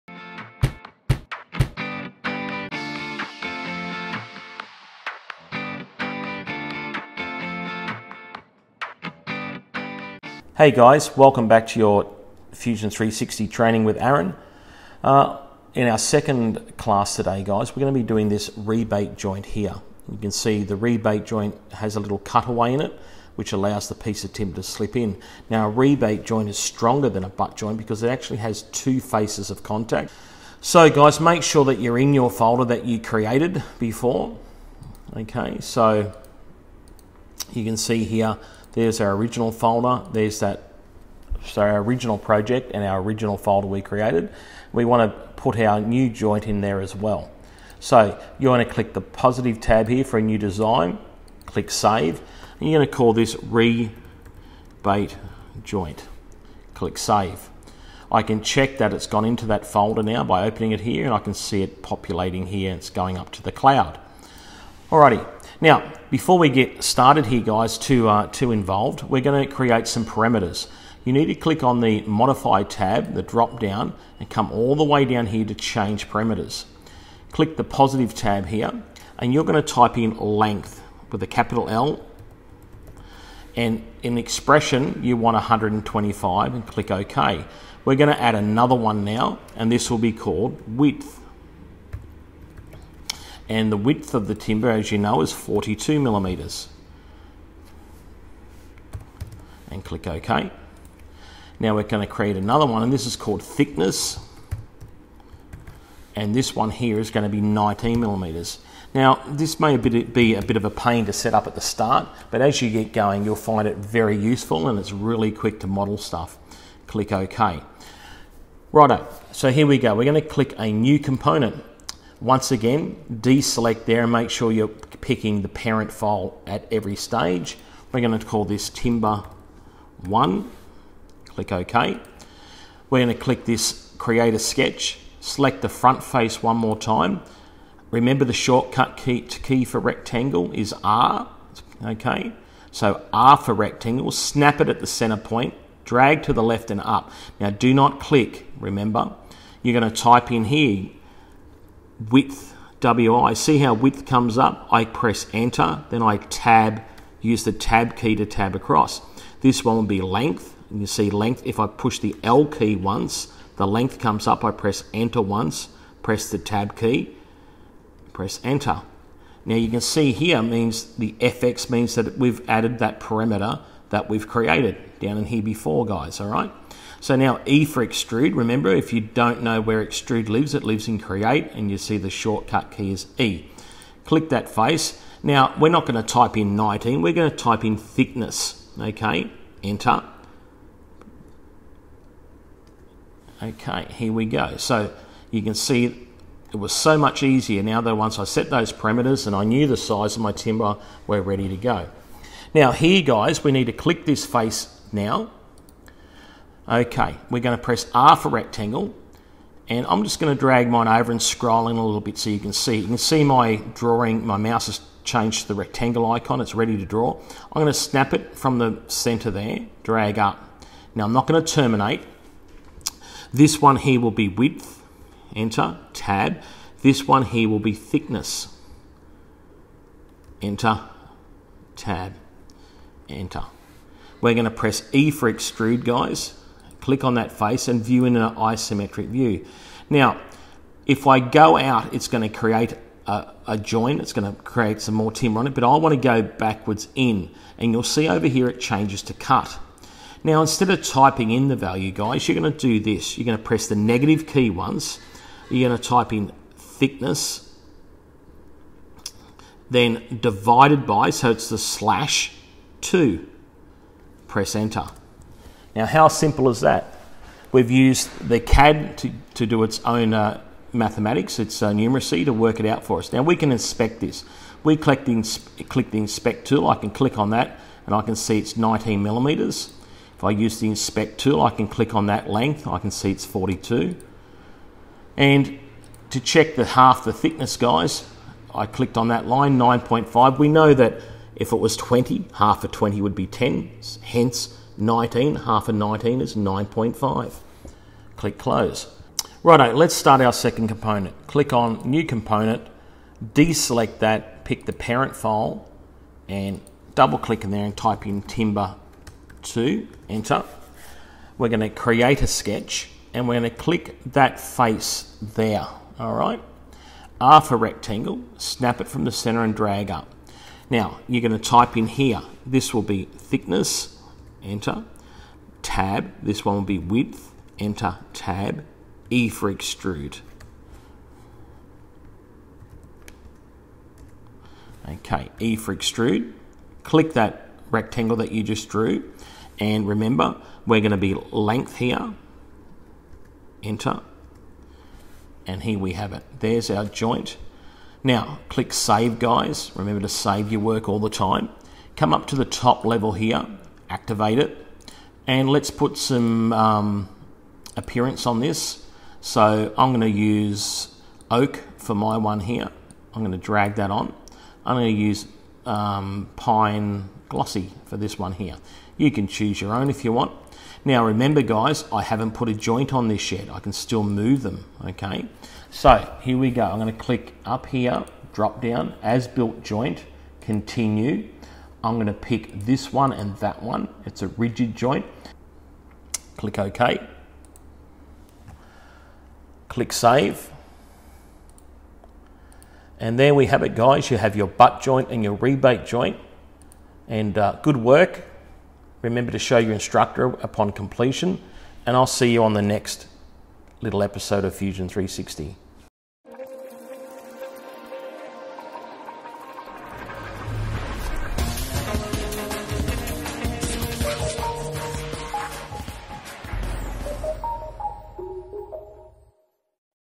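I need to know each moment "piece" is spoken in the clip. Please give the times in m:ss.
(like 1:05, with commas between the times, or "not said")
0:23.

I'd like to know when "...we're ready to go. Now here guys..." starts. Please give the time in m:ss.
3:21.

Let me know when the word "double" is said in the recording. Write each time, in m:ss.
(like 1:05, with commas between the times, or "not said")
5:06.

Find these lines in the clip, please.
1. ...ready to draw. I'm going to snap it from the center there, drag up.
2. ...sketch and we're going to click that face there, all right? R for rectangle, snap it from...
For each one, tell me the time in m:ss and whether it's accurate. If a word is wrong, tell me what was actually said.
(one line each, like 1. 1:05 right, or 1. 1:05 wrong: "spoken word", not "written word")
1. 3:36 right
2. 5:12 right.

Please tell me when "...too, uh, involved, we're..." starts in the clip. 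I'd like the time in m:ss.
1:07.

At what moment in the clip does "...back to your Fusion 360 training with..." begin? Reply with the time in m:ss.
0:11.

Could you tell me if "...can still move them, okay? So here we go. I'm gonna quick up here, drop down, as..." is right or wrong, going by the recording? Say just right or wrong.
wrong.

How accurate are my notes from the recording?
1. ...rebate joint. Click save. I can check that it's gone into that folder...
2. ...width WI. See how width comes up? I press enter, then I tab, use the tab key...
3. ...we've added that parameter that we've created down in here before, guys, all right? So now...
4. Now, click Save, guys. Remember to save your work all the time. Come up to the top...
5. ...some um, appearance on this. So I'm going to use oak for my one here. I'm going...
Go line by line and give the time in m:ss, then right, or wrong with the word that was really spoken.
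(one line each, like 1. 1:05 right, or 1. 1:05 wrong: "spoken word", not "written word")
1. 0:53 right
2. 2:32 right
3. 2:52 right
4. 5:48 right
5. 5:55 right.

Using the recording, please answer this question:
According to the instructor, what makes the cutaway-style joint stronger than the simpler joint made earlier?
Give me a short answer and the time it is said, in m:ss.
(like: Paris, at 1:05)
two faces of contact, at 0:28.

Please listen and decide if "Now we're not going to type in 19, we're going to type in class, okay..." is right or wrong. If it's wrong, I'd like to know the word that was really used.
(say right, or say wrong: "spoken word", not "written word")
wrong: "thickness", not "class".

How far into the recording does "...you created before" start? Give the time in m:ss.
0:32.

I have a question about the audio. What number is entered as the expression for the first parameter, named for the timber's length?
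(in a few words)
125.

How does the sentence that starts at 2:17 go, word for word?
Remember the shortcut key, key for rectangle is R.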